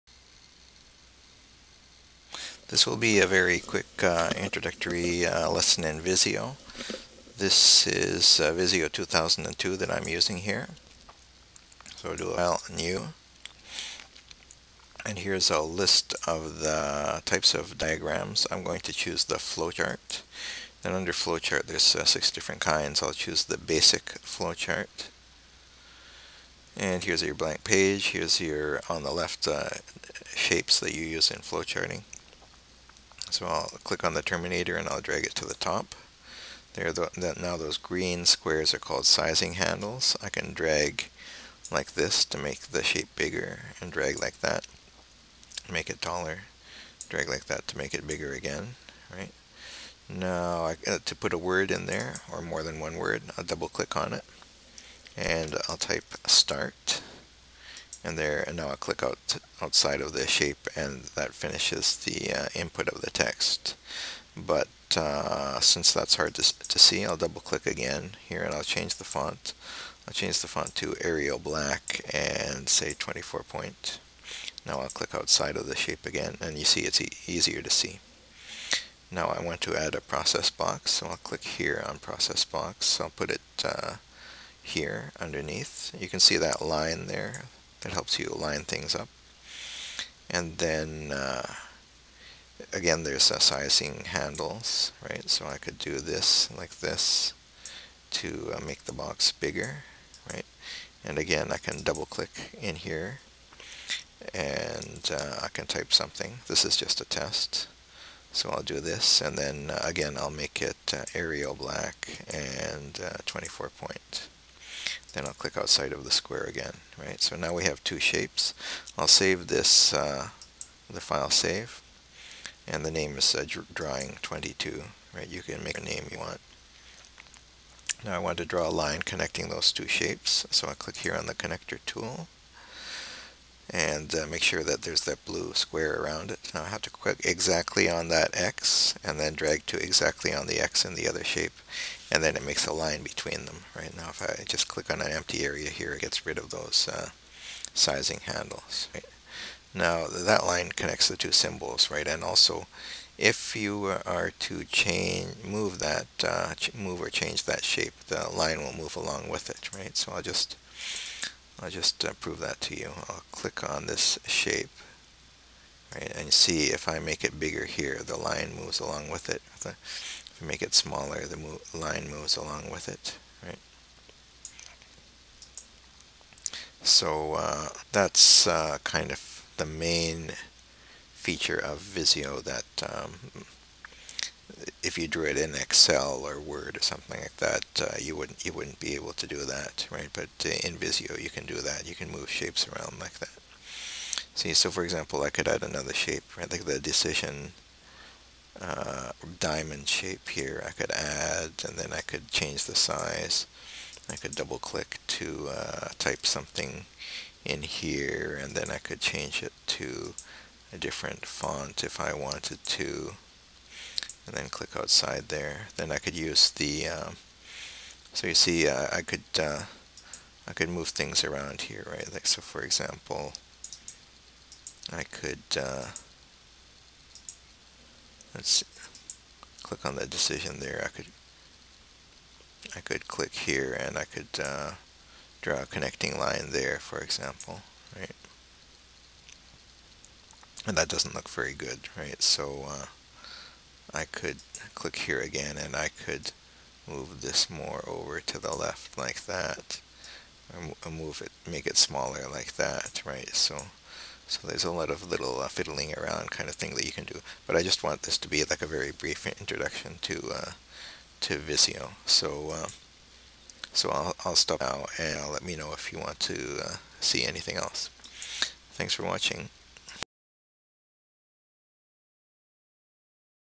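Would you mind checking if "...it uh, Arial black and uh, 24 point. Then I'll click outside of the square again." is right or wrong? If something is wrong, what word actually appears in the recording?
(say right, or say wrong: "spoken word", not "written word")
right.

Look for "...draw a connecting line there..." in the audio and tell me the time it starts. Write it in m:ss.
3:55.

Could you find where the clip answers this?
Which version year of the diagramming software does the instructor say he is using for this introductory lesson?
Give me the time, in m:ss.
0:08.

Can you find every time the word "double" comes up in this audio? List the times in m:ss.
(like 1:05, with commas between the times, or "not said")
0:53, 1:07, 1:41, 3:24.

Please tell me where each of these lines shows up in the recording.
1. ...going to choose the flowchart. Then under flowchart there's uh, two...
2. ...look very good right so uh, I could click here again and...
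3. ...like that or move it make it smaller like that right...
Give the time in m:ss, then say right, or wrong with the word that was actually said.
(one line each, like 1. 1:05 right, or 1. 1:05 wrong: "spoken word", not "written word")
1. 0:18 wrong: "six", not "two"
2. 4:01 right
3. 4:08 right.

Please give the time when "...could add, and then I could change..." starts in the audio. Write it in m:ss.
3:20.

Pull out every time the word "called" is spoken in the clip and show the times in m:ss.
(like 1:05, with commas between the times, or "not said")
0:38.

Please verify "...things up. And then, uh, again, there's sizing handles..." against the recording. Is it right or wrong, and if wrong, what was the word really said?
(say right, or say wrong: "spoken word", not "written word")
right.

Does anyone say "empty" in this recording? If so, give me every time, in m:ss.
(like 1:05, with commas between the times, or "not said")
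2:25.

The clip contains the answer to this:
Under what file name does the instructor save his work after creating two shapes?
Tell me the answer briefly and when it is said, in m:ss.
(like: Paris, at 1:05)
Drawing 22, at 2:03.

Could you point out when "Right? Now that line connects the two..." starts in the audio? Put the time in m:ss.
2:28.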